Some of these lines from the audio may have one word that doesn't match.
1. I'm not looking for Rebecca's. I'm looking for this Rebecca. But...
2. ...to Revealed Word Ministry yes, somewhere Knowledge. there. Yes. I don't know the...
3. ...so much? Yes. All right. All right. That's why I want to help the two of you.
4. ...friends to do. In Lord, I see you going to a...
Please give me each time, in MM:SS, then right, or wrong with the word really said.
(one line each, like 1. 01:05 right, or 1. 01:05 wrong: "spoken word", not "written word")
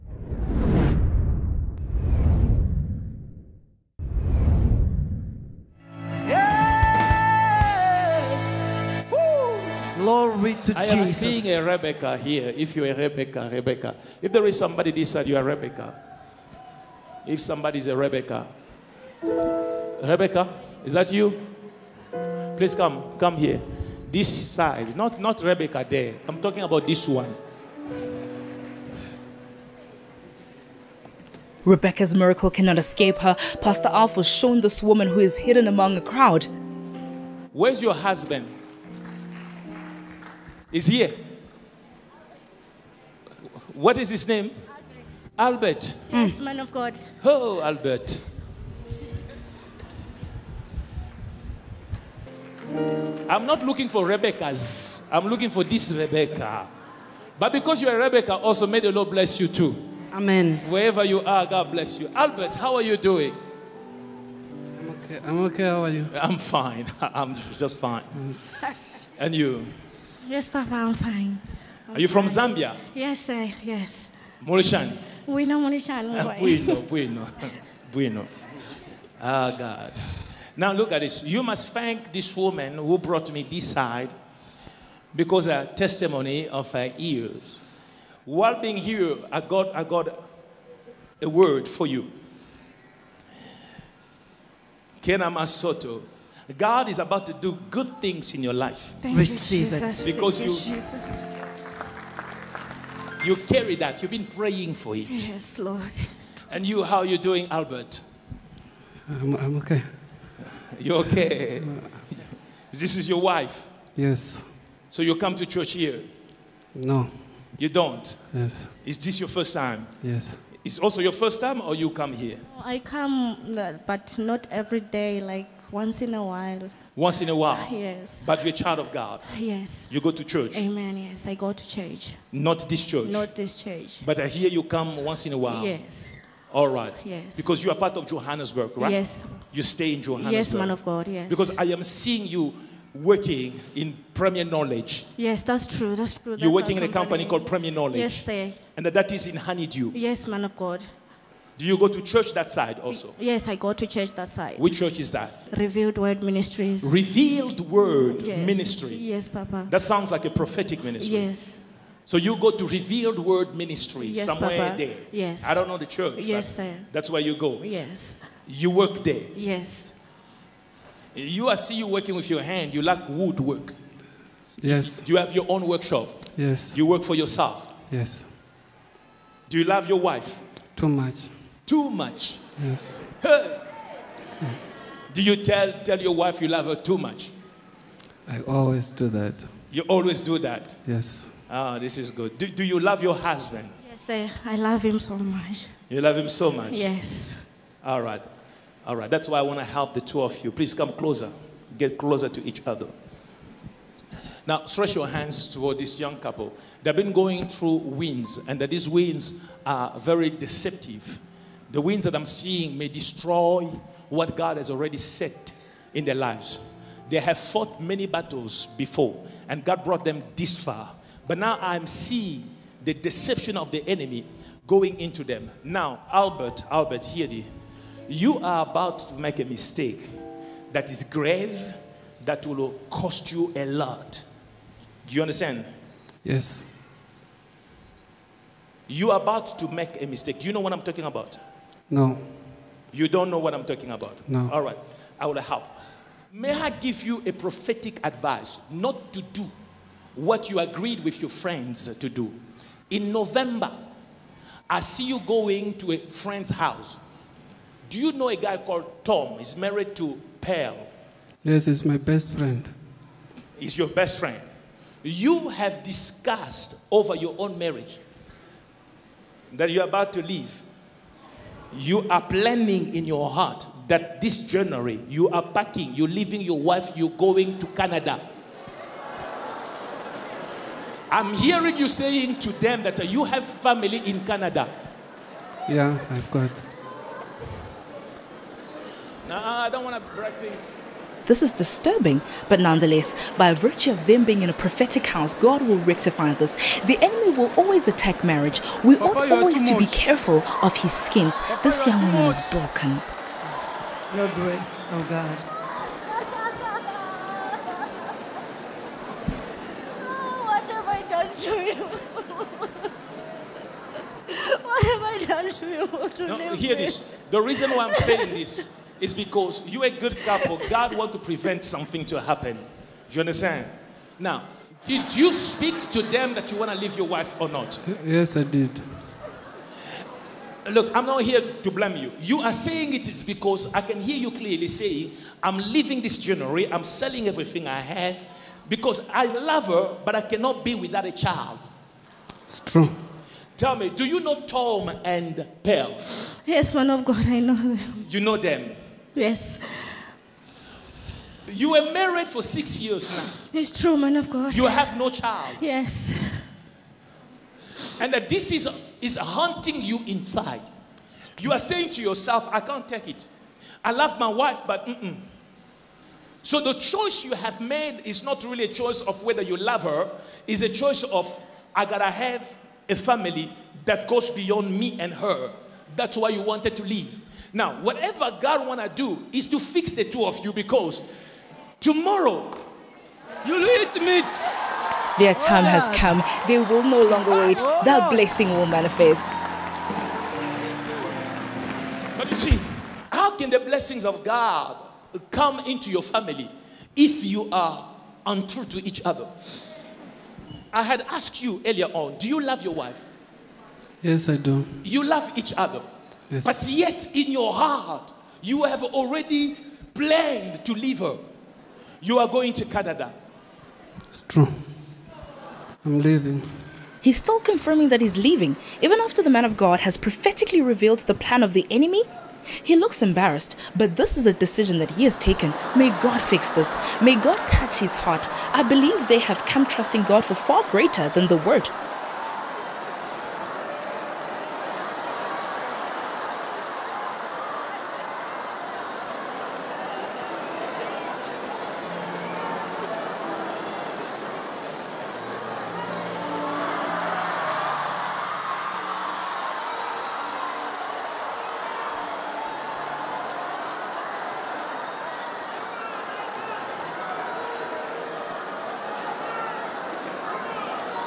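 1. 00:53 right
2. 02:42 wrong: "Papa", not "Knowledge"
3. 03:16 right
4. 04:11 wrong: "November", not "Lord".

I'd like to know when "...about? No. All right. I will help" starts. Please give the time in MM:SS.
04:03.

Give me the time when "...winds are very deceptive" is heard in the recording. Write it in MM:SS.
03:28.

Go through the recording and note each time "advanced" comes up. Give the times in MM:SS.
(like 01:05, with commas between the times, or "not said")
not said.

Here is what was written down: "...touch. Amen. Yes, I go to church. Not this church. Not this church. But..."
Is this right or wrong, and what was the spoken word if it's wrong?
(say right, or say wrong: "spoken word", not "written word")
wrong: "church", not "touch".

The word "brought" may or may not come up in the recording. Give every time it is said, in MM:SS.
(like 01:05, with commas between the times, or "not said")
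01:22, 03:39.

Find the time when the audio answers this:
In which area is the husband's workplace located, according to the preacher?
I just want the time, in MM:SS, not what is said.
02:29.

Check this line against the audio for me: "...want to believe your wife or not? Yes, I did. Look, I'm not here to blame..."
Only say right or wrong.
wrong.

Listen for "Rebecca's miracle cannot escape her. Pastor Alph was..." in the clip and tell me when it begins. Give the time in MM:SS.
00:31.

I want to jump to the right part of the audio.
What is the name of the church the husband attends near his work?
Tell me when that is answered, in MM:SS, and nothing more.
02:35.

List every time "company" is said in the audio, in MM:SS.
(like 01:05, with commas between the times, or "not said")
02:26.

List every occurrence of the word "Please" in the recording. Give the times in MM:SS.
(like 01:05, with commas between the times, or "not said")
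00:22, 03:20.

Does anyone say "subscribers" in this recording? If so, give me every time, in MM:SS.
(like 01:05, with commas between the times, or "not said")
not said.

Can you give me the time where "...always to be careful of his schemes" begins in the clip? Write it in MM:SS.
04:59.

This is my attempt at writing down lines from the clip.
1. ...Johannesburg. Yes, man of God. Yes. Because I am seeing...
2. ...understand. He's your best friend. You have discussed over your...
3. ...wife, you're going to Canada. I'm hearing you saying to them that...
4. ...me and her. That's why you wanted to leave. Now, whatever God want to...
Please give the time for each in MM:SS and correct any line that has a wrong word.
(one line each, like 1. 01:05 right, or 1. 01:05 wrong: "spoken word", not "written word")
1. 02:20 right
2. 04:22 wrong: "friend", not "understand"
3. 04:36 right
4. 06:14 right.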